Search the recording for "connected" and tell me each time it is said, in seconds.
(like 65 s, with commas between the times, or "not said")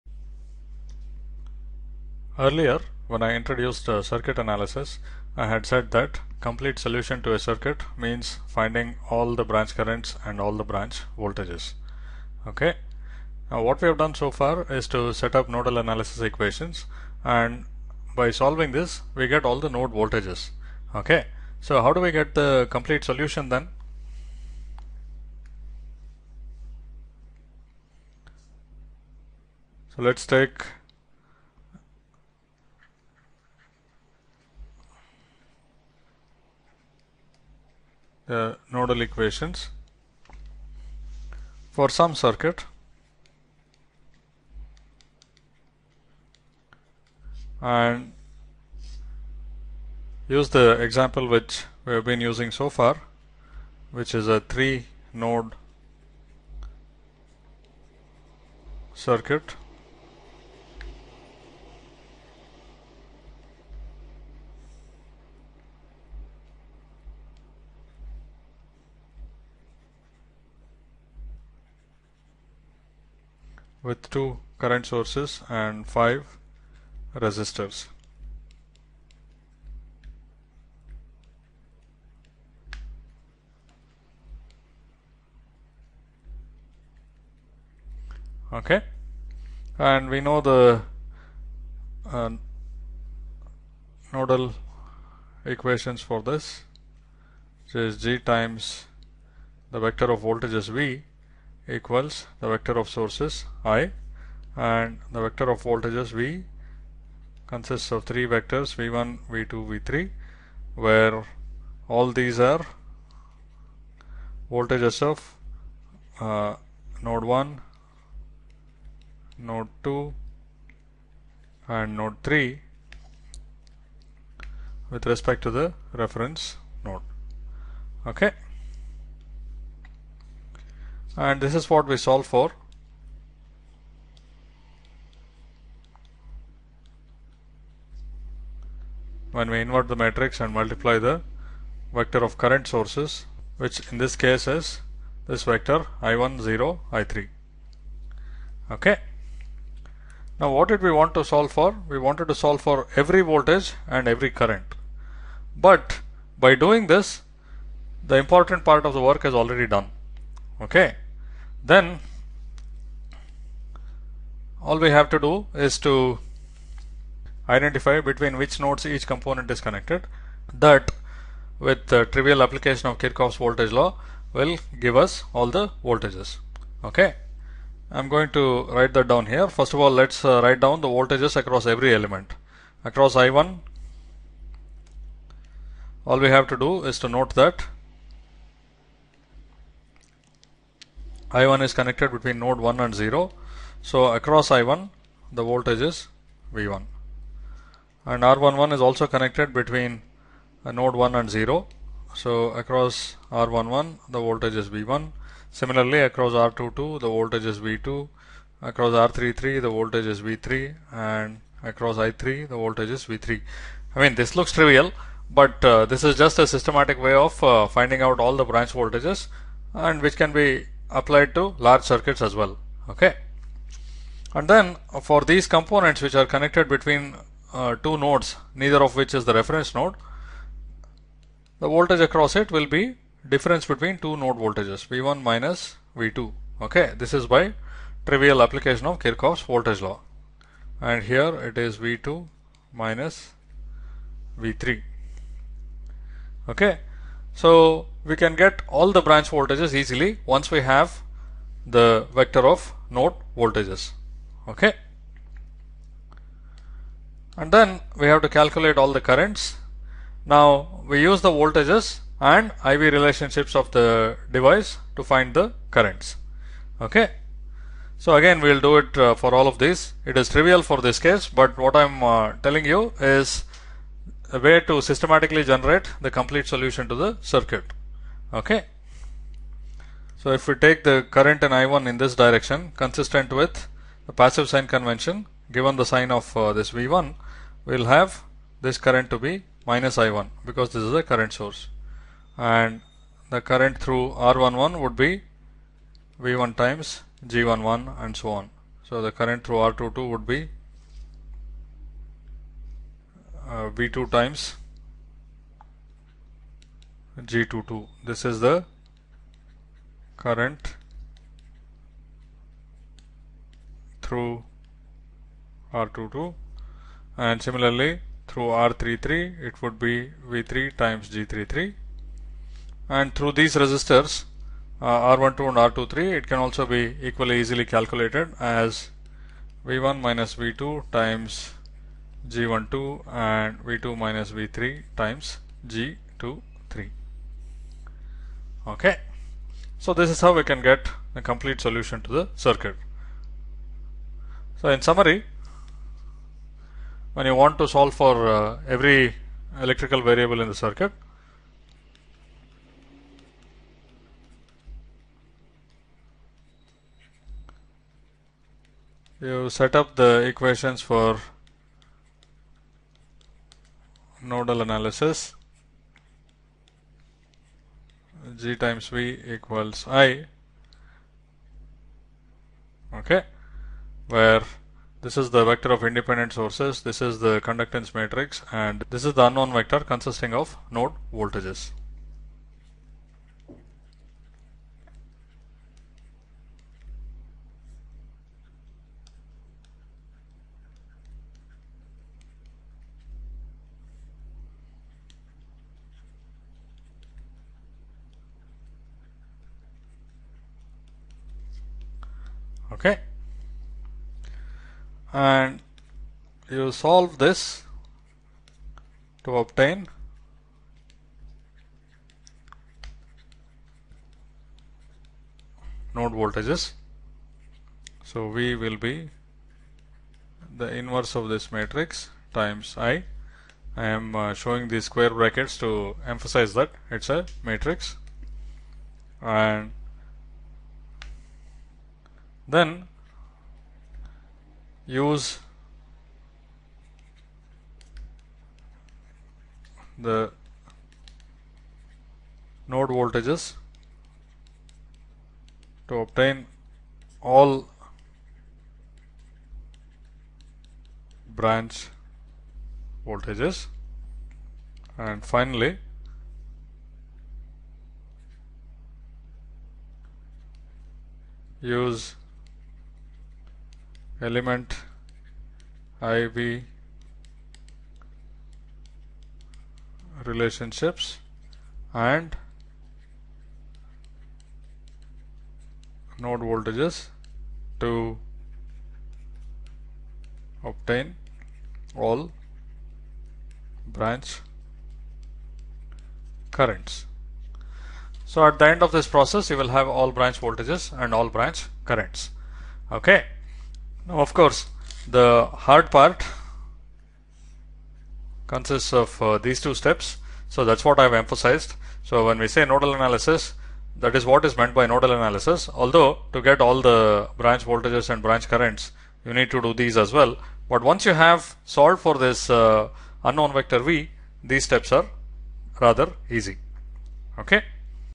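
169 s, 191 s, 199 s, 226 s.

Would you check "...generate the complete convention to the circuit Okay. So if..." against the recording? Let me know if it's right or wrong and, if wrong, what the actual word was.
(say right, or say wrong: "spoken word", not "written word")
wrong: "solution", not "convention".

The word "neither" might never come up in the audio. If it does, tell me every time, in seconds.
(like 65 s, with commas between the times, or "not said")
228 s.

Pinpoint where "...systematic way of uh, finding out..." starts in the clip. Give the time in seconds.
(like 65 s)
216 s.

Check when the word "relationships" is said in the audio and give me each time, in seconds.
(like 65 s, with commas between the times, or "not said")
262 s, 470 s.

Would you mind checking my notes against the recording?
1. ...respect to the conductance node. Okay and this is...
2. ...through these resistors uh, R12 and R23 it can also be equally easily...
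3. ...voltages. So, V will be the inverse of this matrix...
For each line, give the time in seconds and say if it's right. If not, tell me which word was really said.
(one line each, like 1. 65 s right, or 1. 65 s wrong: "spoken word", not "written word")
1. 125 s wrong: "reference", not "conductance"
2. 323 s right
3. 416 s right.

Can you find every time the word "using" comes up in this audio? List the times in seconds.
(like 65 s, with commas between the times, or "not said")
52 s.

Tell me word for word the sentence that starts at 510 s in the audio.
But once you have solved for this uh, unknown vector v, these steps are rather easy.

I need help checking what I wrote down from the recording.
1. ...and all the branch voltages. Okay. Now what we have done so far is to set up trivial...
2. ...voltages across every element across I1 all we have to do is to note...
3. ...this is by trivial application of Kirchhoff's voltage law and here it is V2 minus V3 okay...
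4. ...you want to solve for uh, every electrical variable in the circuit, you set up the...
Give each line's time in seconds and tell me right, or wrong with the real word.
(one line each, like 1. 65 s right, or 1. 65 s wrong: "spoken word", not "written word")
1. 10 s wrong: "nodal", not "trivial"
2. 180 s right
3. 236 s right
4. 347 s right.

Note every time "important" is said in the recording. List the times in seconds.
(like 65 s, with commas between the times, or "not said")
158 s.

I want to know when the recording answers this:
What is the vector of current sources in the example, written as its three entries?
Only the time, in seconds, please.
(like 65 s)
146 s.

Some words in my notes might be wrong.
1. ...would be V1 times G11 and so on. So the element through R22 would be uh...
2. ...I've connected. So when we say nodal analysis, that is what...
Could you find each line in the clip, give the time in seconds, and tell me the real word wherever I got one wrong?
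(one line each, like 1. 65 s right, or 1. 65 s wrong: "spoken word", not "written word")
1. 294 s wrong: "current", not "element"
2. 500 s wrong: "emphasized", not "connected".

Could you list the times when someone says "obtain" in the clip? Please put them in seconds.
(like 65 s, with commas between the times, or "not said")
409 s, 446 s, 480 s.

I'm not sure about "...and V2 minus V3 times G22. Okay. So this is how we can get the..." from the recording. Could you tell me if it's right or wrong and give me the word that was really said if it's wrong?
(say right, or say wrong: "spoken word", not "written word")
right.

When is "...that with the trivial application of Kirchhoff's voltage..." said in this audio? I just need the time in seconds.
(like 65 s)
170 s.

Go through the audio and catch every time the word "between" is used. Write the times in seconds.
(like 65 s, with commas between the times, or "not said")
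167 s, 192 s, 199 s, 226 s, 233 s.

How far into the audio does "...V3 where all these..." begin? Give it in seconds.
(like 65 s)
109 s.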